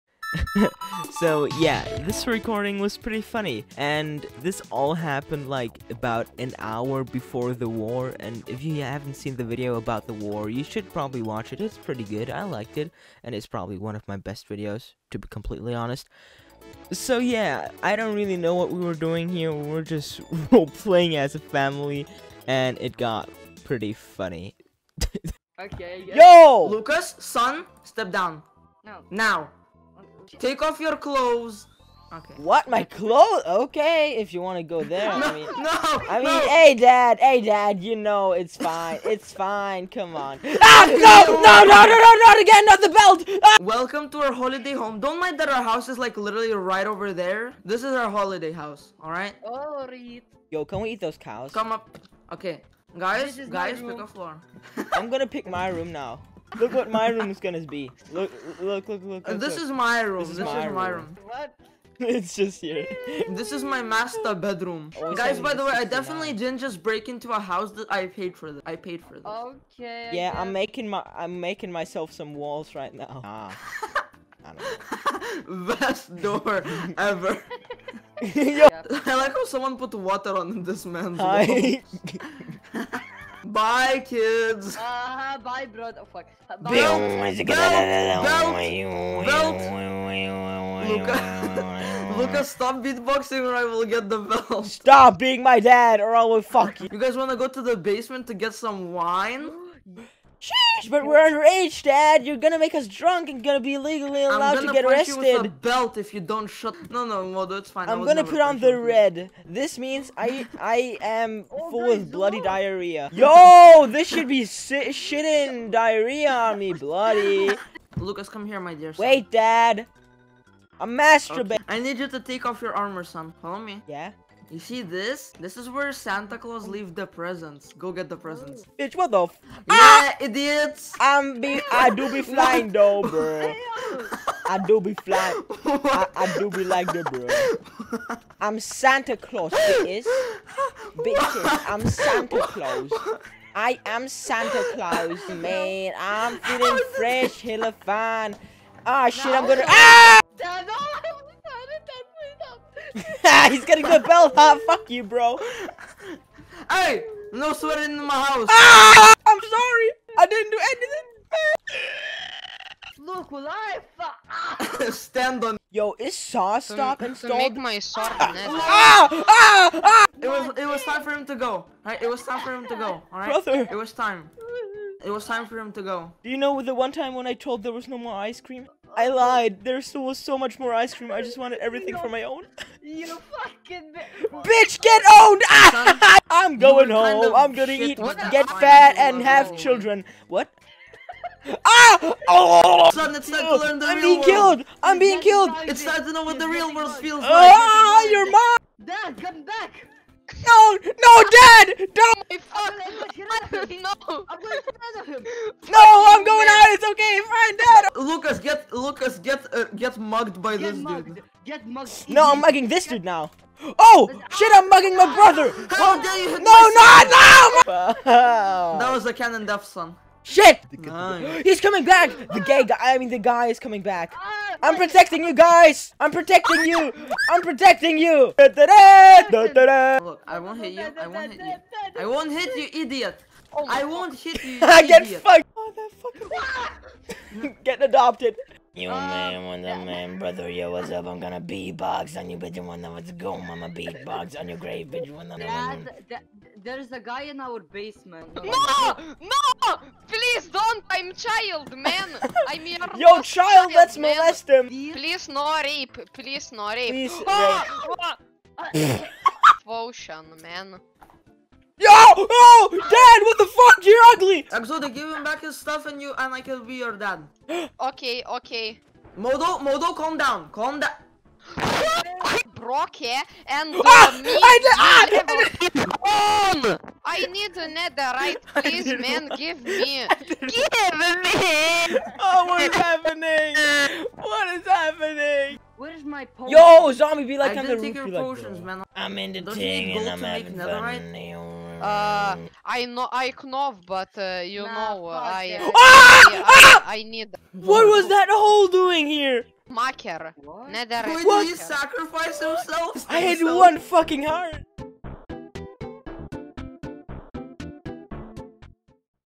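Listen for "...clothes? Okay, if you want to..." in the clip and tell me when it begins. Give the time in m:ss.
0:32.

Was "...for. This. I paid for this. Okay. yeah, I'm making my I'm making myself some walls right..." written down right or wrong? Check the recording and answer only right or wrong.
right.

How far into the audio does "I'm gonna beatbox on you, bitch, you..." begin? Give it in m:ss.
4:01.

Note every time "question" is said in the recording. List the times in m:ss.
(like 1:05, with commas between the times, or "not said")
not said.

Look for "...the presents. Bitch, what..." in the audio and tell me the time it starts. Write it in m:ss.
2:08.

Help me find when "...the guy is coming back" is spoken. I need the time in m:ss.
3:43.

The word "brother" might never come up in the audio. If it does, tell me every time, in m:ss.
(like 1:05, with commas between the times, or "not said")
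1:25, 2:53, 3:35, 4:00.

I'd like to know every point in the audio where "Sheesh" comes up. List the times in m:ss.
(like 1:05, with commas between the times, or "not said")
1:40.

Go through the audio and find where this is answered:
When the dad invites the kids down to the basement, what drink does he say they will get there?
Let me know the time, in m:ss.
1:38.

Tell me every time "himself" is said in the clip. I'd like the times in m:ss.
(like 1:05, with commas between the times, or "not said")
5:02.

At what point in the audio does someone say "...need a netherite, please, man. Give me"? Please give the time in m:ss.
4:37.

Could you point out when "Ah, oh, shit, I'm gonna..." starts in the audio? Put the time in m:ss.
2:28.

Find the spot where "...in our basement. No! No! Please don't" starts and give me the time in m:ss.
4:07.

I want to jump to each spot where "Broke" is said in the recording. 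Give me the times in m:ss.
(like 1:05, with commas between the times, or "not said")
4:32.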